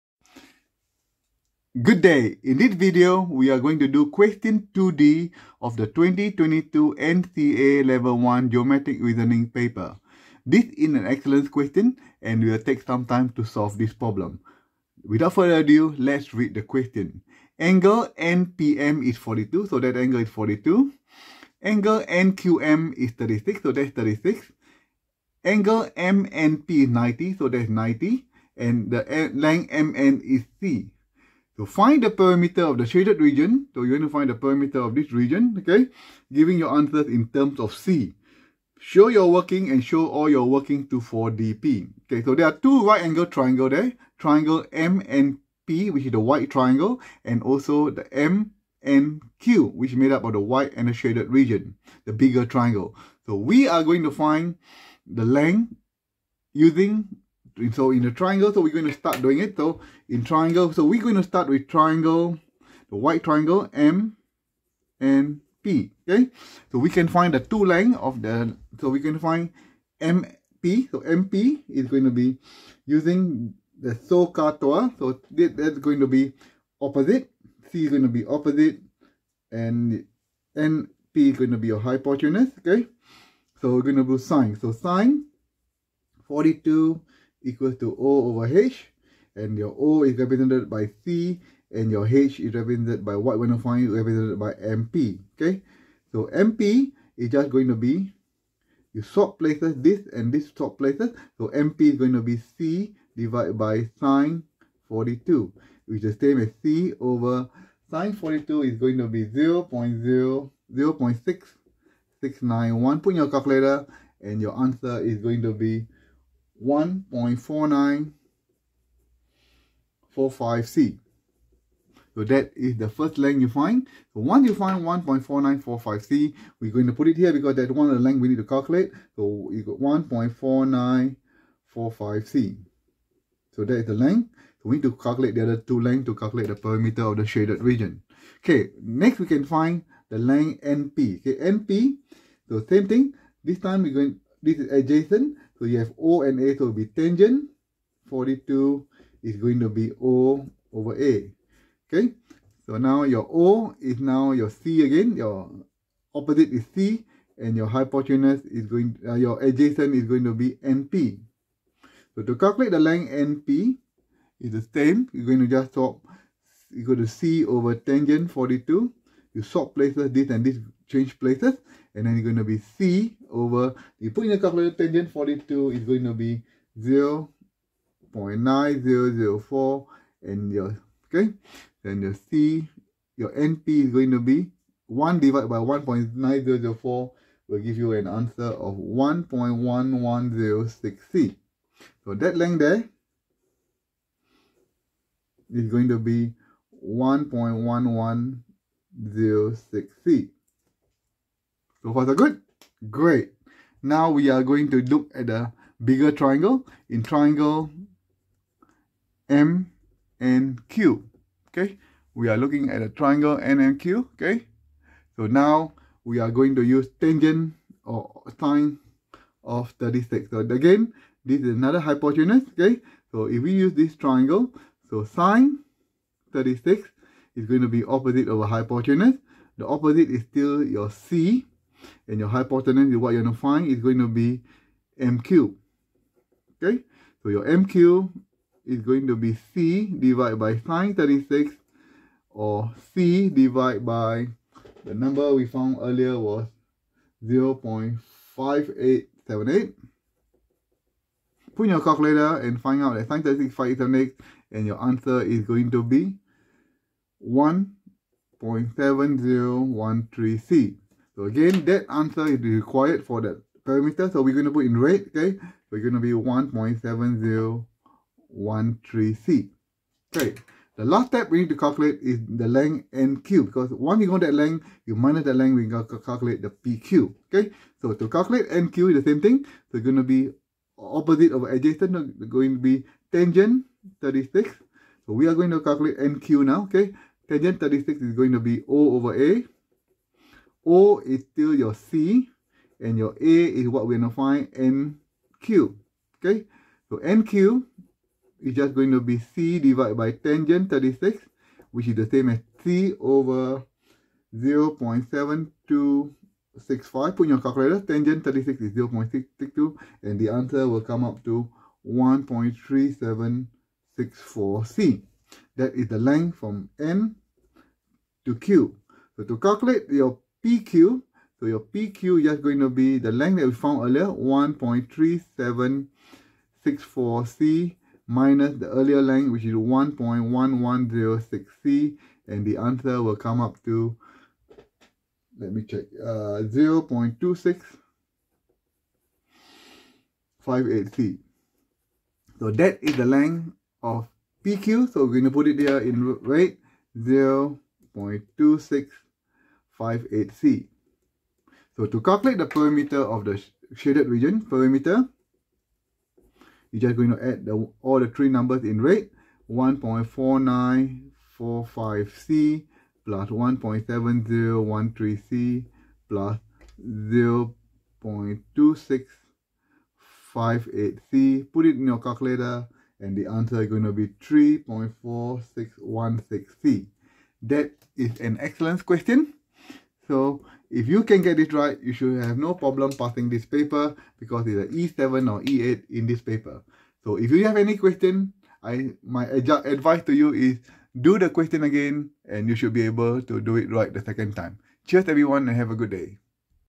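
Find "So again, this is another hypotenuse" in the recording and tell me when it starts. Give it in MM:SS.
03:40.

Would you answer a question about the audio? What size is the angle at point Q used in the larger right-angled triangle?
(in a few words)
36.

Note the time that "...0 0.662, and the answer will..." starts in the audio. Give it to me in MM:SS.
05:08.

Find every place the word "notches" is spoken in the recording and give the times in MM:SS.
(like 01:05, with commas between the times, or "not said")
not said.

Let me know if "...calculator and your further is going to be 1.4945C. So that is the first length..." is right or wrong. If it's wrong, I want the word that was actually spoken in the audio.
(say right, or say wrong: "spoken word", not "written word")
wrong: "answer", not "further".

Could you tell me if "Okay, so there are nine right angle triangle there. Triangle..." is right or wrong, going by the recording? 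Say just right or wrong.
wrong.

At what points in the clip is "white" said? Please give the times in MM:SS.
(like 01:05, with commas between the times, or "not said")
00:46, 00:50, 01:02.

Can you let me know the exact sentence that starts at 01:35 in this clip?
Okay, so MP is just going to be you swap places this and this swap places.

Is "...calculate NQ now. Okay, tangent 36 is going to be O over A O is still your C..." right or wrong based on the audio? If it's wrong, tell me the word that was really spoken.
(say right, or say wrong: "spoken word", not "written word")
right.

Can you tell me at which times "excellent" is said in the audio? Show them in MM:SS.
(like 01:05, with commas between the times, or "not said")
00:11, 06:18.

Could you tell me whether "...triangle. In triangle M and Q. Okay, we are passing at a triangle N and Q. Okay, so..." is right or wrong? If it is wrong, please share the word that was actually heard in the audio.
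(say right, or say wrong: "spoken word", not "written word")
wrong: "looking", not "passing".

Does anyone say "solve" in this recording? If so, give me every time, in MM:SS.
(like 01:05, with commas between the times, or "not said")
00:13.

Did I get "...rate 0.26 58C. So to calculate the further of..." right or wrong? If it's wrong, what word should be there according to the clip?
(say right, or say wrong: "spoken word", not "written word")
wrong: "perimeter", not "further".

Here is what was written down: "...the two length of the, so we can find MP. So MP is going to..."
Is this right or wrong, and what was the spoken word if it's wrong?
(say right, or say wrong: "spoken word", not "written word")
right.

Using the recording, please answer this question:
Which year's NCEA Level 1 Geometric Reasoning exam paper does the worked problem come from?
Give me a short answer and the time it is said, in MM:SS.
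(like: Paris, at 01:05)
2022, at 00:05.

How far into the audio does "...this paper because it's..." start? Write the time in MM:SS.
06:23.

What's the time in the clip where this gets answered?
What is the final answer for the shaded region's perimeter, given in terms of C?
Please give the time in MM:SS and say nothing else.
06:14.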